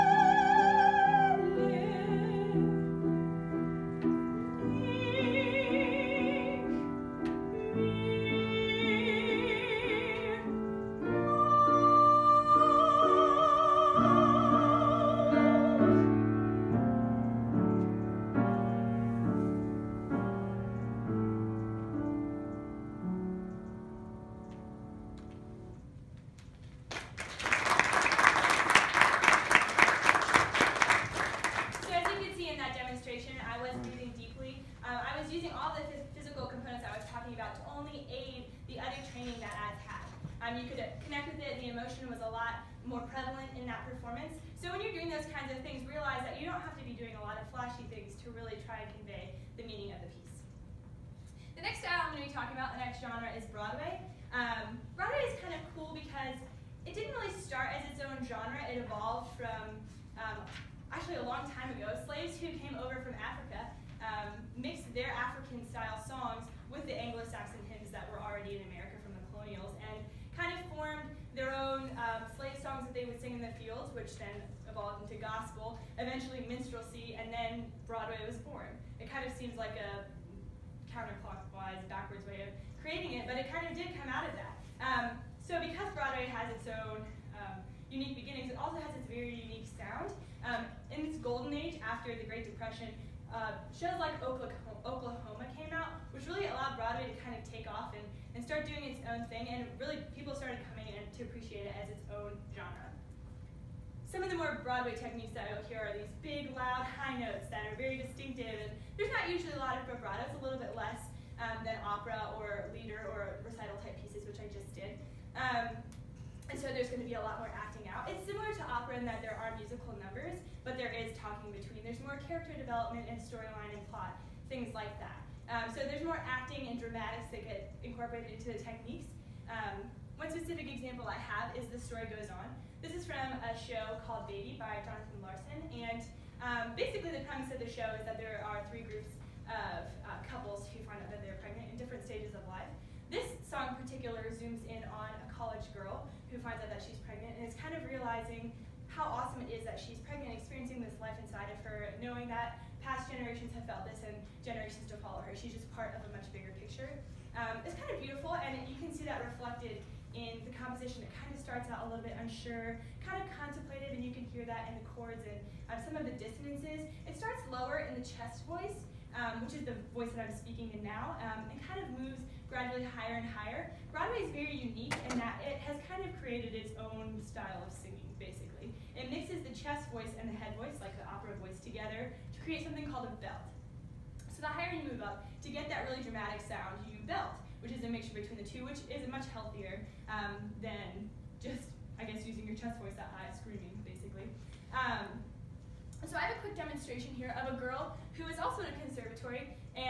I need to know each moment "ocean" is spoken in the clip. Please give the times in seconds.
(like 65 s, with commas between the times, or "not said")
not said.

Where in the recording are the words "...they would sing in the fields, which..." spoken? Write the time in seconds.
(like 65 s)
72 s.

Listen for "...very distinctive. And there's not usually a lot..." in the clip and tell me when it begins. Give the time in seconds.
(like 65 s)
107 s.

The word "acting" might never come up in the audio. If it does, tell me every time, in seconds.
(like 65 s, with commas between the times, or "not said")
117 s, 126 s.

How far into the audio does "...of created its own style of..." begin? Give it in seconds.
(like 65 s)
176 s.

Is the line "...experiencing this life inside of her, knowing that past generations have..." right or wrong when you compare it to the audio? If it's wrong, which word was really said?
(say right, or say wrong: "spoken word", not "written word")
right.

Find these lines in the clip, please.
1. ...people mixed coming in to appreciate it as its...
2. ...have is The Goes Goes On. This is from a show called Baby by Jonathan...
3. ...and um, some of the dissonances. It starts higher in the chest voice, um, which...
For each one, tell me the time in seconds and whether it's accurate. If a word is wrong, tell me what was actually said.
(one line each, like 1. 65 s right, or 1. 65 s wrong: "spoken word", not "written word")
1. 100 s wrong: "started", not "mixed"
2. 131 s wrong: "Story", not "Goes"
3. 165 s wrong: "lower", not "higher".